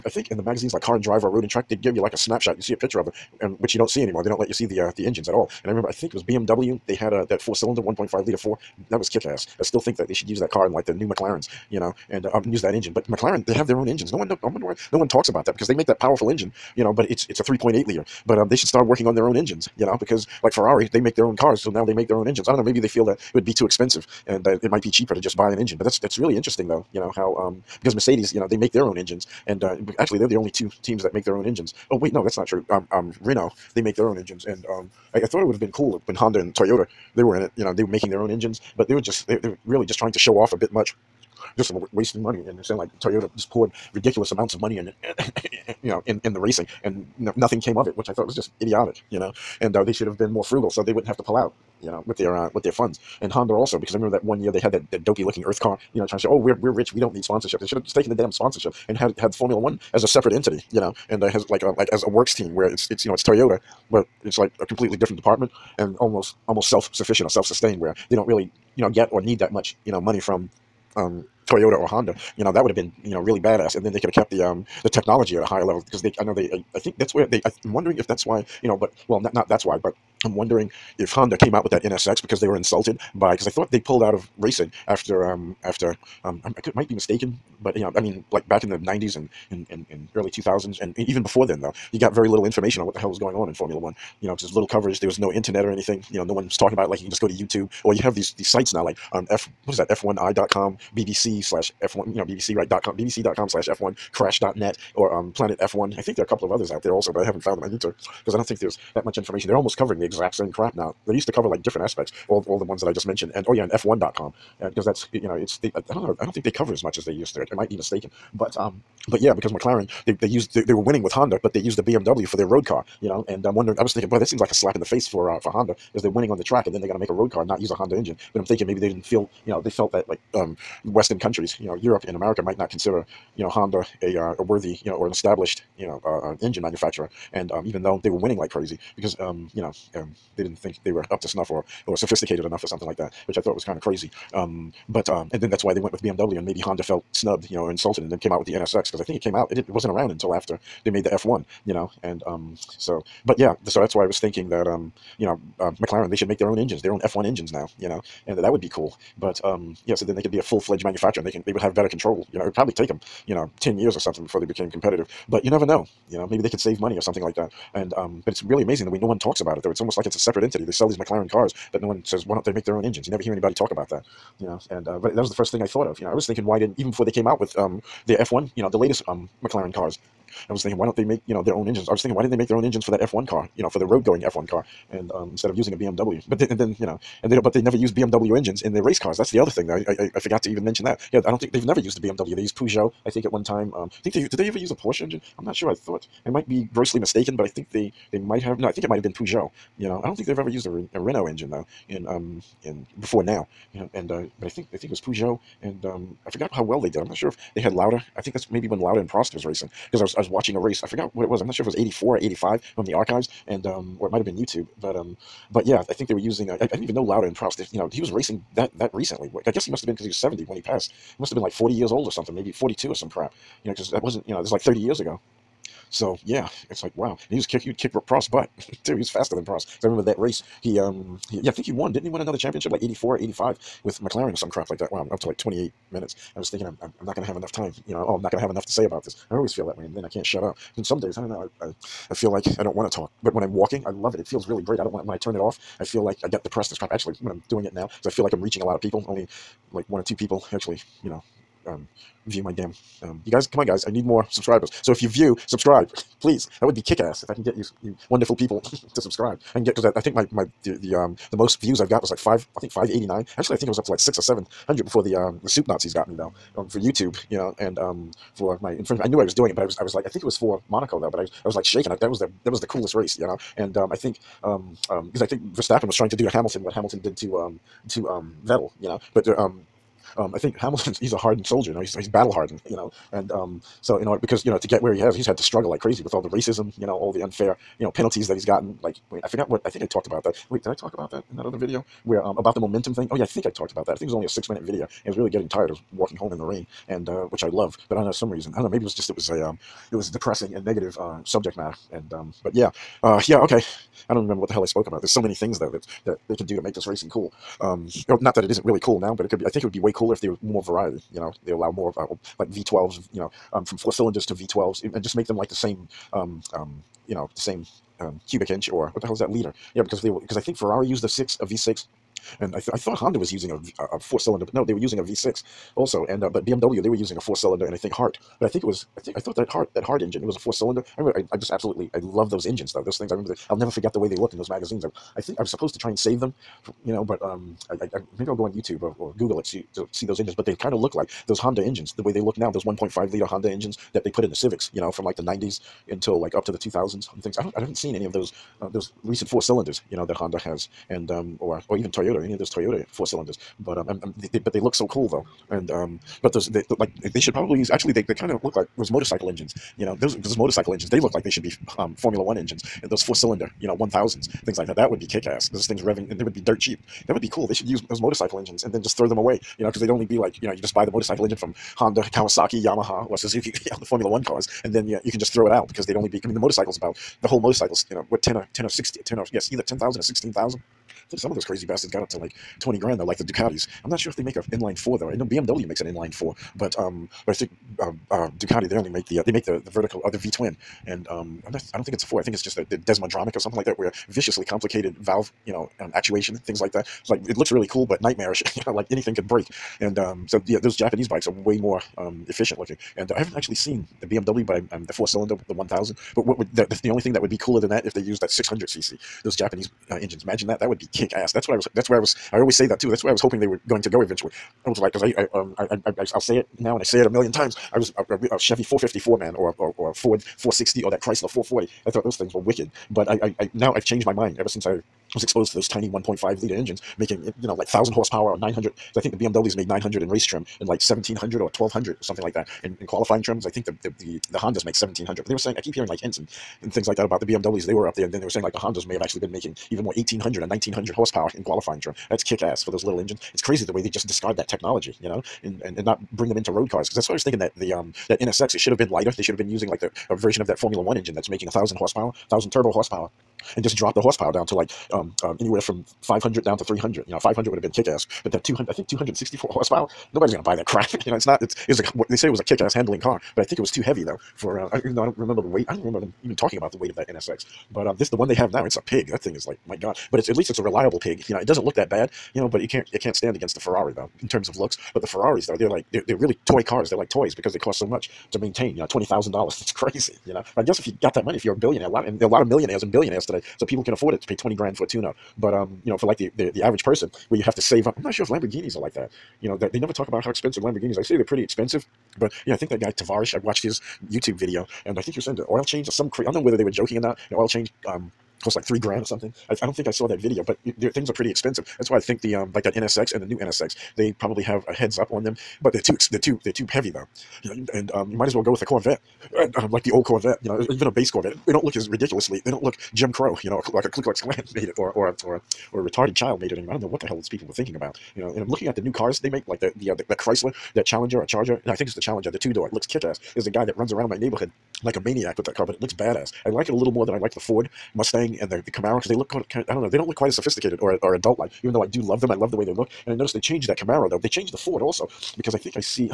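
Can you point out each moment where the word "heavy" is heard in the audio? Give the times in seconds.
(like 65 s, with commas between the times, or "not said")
463 s, 506 s.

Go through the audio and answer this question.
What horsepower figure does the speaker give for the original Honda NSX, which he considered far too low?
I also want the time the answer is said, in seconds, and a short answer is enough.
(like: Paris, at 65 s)
264, at 458 s.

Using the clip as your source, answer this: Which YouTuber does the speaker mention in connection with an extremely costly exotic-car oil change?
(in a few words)
Tavarish.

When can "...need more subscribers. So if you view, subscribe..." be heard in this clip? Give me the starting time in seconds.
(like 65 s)
253 s.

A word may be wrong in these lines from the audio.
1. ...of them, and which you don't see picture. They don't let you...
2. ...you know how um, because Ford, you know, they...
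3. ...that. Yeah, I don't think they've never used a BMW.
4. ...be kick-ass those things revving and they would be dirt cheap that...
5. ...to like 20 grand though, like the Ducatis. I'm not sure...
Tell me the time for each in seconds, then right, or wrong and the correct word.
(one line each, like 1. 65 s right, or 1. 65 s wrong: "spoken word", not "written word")
1. 2 s wrong: "anymore", not "picture"
2. 26 s wrong: "Mercedes", not "Ford"
3. 190 s right
4. 364 s right
5. 382 s right.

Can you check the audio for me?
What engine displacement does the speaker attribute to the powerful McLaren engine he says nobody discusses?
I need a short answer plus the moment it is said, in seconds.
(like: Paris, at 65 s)
3.8 liter, at 17 s.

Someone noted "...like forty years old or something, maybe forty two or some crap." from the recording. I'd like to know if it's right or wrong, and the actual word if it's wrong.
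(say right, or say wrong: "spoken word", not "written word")
right.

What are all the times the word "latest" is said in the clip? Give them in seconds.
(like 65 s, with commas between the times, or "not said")
178 s.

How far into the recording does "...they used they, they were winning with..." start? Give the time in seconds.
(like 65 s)
120 s.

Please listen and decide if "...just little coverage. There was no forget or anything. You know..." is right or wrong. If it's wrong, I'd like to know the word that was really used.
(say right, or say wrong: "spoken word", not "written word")
wrong: "internet", not "forget".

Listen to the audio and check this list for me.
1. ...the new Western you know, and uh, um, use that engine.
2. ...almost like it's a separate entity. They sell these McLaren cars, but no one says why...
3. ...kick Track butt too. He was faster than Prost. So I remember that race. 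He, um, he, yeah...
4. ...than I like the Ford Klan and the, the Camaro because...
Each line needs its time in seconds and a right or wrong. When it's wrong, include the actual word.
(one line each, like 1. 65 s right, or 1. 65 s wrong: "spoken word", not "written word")
1. 10 s wrong: "McLarens", not "Western"
2. 169 s right
3. 227 s wrong: "Prost", not "Track"
4. 527 s wrong: "Mustang", not "Klan".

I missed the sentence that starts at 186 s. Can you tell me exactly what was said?
But then, and then you know, and they don't.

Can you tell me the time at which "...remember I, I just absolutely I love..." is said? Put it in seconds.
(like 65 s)
330 s.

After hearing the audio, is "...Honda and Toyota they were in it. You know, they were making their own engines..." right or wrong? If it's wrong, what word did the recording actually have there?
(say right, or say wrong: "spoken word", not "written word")
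right.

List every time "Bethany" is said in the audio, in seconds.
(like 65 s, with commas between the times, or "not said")
not said.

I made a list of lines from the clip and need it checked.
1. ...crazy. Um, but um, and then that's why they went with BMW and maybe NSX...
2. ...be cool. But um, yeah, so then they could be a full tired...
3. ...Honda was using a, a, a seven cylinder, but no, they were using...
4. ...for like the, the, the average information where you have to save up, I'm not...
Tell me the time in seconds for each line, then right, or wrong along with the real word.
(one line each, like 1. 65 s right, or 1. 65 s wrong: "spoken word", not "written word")
1. 143 s wrong: "Honda", not "NSX"
2. 158 s wrong: "fledged", not "tired"
3. 322 s wrong: "four", not "seven"
4. 485 s wrong: "person", not "information".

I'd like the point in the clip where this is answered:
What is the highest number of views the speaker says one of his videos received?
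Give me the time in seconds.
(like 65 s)
262 s.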